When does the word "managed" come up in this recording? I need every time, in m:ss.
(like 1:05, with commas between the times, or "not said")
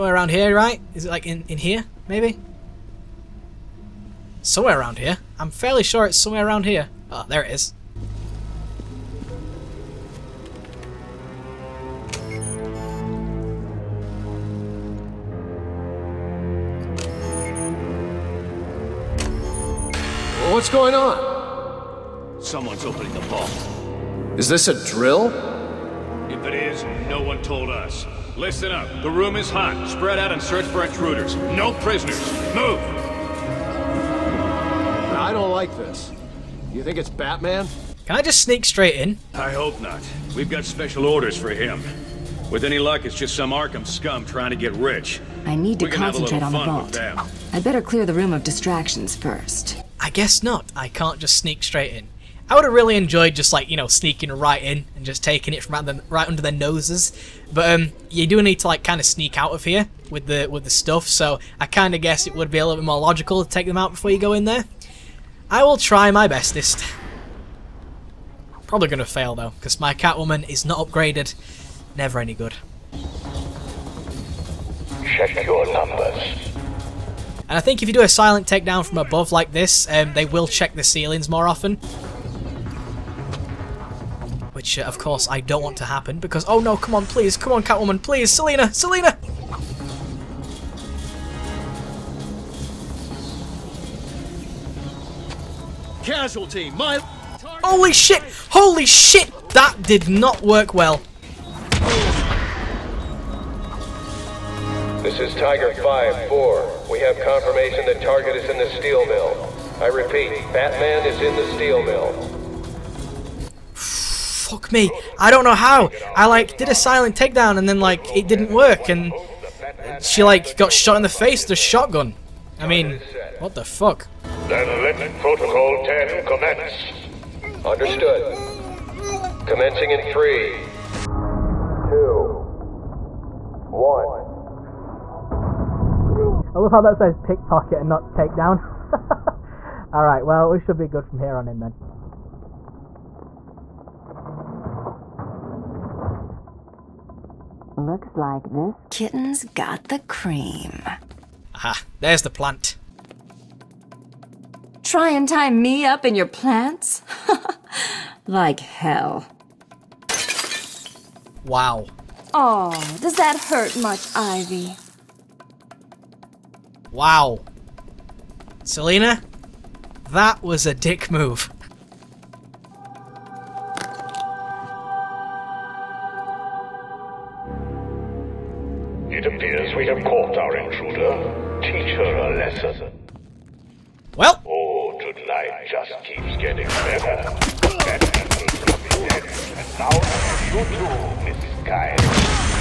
not said.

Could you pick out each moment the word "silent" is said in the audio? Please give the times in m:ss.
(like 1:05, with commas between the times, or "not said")
1:18, 1:56.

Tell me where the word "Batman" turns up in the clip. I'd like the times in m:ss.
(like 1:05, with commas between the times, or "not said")
0:37, 1:50.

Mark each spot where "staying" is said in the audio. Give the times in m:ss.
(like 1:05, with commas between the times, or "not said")
not said.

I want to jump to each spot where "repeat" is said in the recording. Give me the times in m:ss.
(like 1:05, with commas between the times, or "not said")
1:49.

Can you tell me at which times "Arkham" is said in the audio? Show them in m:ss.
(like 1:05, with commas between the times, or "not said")
0:43.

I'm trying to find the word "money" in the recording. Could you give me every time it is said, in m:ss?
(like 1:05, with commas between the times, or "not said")
not said.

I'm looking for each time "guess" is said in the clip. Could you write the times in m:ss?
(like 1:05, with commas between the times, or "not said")
0:50, 1:02.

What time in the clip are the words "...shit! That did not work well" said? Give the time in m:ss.
1:38.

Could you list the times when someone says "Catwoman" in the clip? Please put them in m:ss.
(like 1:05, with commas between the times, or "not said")
1:09, 1:27.